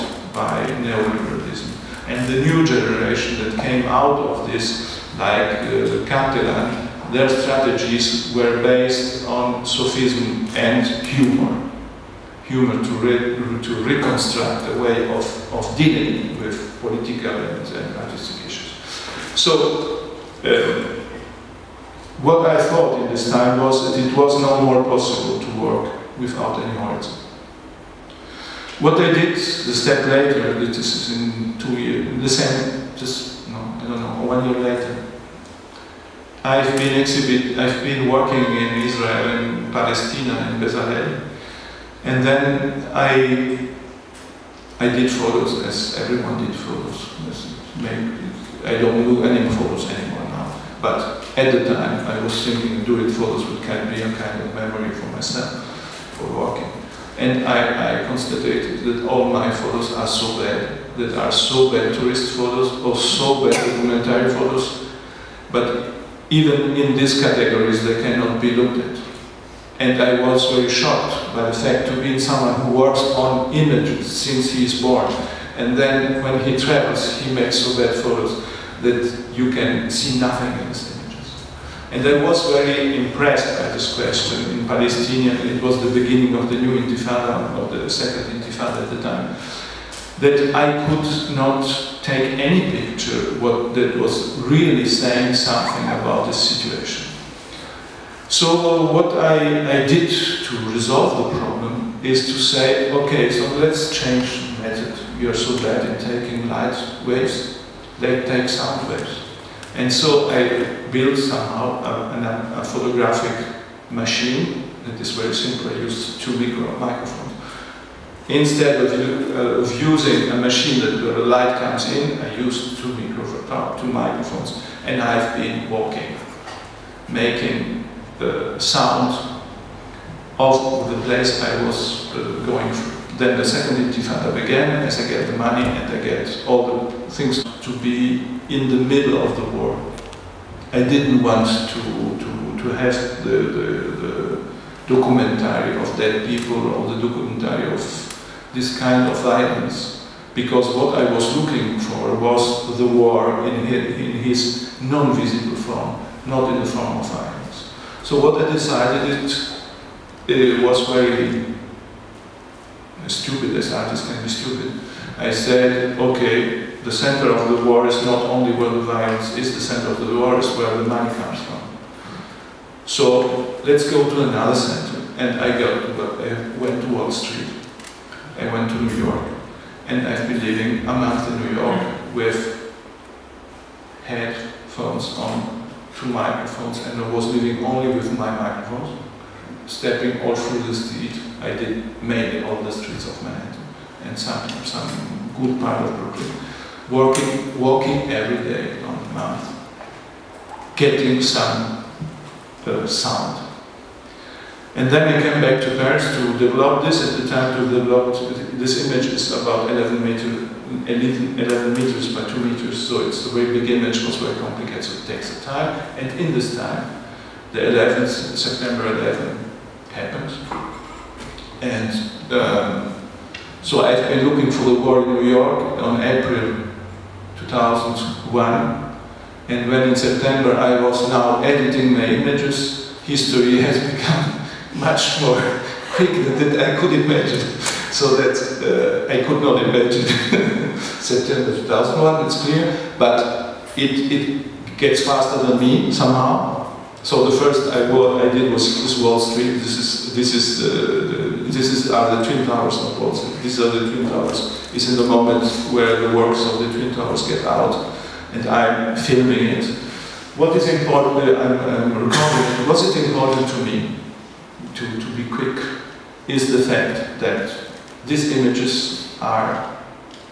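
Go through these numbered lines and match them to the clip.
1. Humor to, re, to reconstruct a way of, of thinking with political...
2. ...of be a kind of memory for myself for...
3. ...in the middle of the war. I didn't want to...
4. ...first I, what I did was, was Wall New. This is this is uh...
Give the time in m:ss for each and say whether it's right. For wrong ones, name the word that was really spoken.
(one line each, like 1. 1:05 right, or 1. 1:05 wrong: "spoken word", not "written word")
1. 0:12 wrong: "dealing", not "thinking"
2. 0:53 right
3. 2:18 right
4. 4:07 wrong: "Street", not "New".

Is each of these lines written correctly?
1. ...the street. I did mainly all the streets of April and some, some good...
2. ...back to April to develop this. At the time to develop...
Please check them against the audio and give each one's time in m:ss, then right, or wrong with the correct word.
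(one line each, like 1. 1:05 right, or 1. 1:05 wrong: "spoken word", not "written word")
1. 3:10 wrong: "Manhattan", not "April"
2. 3:25 wrong: "Paris", not "April".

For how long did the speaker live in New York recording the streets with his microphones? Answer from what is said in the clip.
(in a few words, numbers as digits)
A month.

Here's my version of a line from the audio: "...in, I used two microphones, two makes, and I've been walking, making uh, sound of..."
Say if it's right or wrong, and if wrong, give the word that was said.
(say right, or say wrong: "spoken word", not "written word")
wrong: "microphones", not "makes".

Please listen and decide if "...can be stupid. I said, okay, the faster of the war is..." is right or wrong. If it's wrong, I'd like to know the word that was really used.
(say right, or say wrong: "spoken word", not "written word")
wrong: "center", not "faster".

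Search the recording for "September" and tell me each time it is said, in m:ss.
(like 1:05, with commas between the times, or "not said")
3:38, 3:49, 4:01.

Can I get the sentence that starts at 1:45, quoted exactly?
We are so bad in taking light waves, let's take sound waves.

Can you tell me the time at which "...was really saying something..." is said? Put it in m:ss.
1:33.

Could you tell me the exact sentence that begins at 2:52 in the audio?
So let's go to another center.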